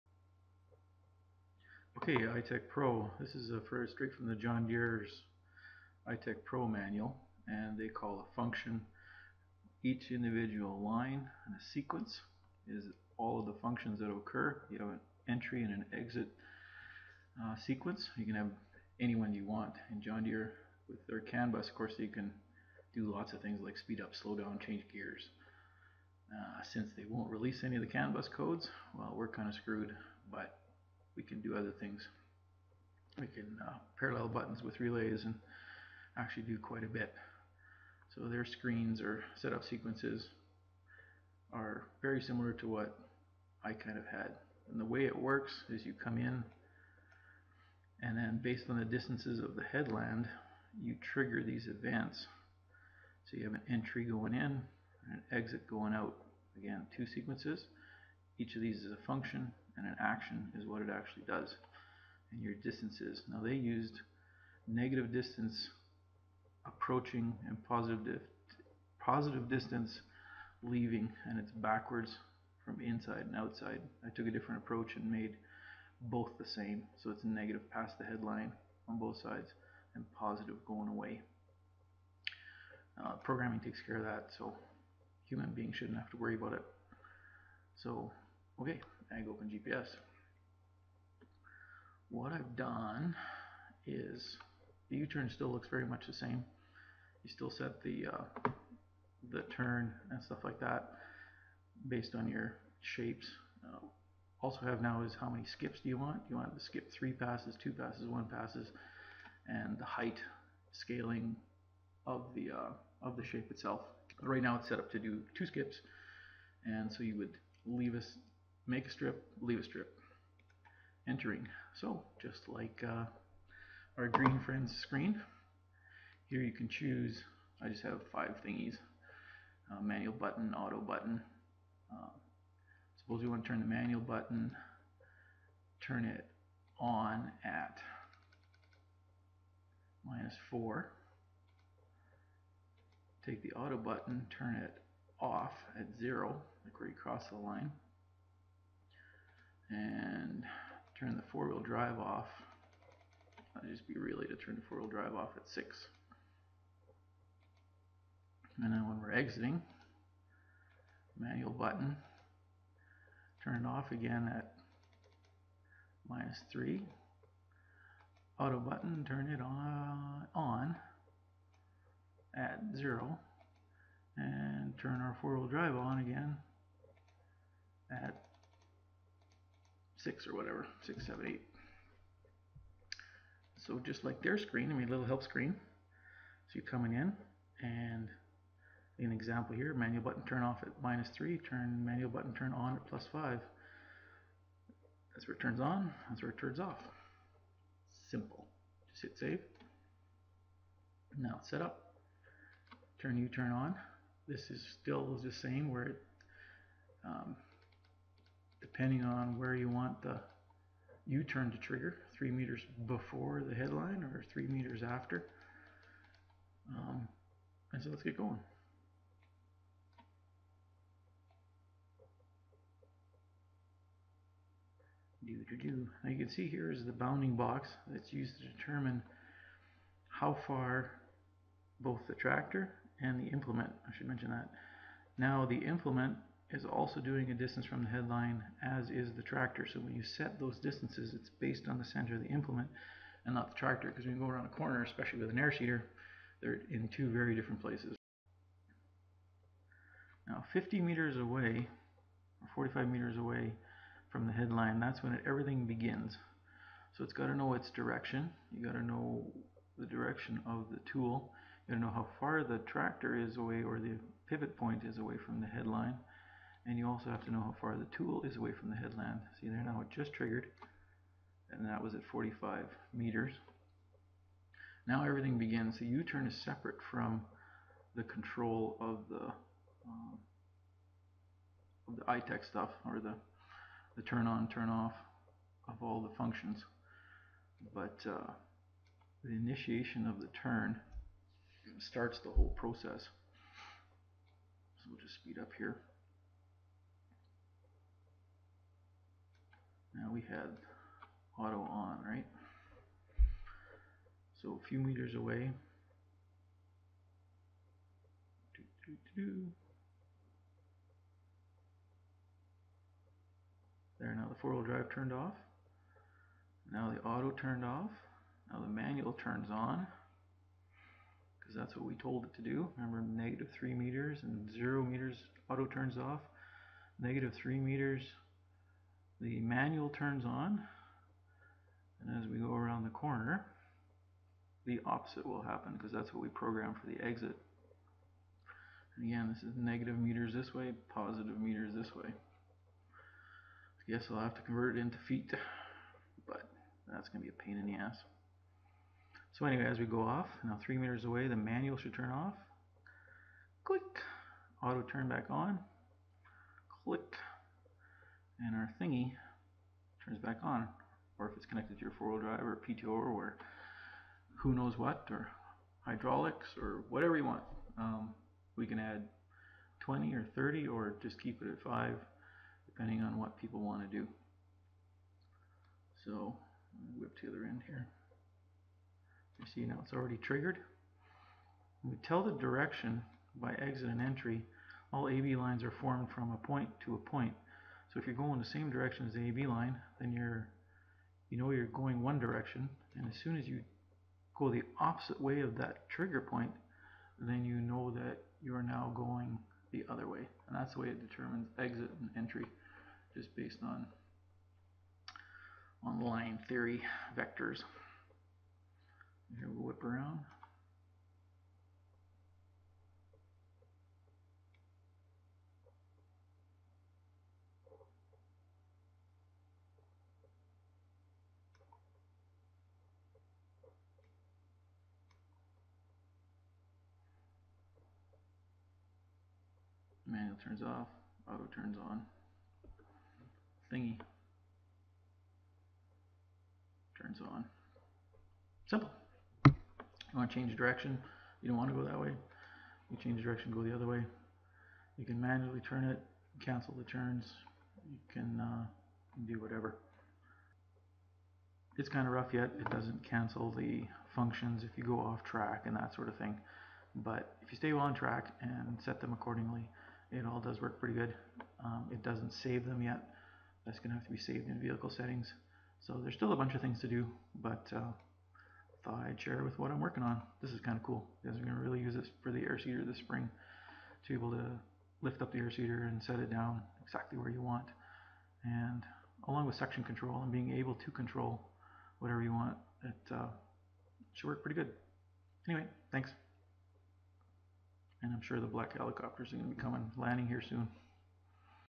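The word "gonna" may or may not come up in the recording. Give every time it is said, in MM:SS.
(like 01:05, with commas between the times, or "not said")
05:47.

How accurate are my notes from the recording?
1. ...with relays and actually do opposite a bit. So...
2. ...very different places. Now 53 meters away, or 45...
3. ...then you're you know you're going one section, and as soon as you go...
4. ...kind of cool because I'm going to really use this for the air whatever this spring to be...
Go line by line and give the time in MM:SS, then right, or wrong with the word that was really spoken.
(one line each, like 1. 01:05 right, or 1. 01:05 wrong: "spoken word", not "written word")
1. 00:34 wrong: "quite", not "opposite"
2. 04:07 wrong: "50", not "53"
3. 06:29 wrong: "direction", not "section"
4. 07:50 wrong: "seeder", not "whatever".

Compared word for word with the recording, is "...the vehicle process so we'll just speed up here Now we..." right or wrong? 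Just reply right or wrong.
wrong.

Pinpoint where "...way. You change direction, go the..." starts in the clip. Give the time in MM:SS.
07:21.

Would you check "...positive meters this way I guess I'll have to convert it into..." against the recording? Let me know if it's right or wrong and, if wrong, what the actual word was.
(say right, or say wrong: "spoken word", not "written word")
right.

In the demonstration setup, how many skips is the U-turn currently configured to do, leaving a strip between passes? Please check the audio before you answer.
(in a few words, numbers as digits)
2.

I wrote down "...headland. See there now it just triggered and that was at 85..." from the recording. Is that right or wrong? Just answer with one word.
wrong.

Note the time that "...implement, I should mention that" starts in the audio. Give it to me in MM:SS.
03:53.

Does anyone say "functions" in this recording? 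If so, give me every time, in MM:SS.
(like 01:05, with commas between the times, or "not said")
00:08, 00:13, 00:59, 04:46, 07:34.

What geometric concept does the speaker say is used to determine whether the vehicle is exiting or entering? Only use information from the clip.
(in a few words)
line theory vectors.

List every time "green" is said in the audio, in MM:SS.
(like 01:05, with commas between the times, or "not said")
02:04.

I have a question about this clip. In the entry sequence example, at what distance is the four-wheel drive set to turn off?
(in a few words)
6.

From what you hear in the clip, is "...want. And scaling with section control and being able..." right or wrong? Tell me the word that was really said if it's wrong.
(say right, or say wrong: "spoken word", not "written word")
wrong: "along", not "scaling".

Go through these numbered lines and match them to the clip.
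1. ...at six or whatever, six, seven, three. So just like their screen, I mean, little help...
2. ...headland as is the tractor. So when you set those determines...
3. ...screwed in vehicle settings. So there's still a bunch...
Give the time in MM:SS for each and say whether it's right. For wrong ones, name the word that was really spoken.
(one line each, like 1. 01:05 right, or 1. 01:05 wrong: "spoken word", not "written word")
1. 02:57 wrong: "eight", not "three"
2. 03:57 wrong: "distances", not "determines"
3. 07:44 wrong: "saved", not "screwed".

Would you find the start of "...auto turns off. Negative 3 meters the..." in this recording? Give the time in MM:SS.
05:25.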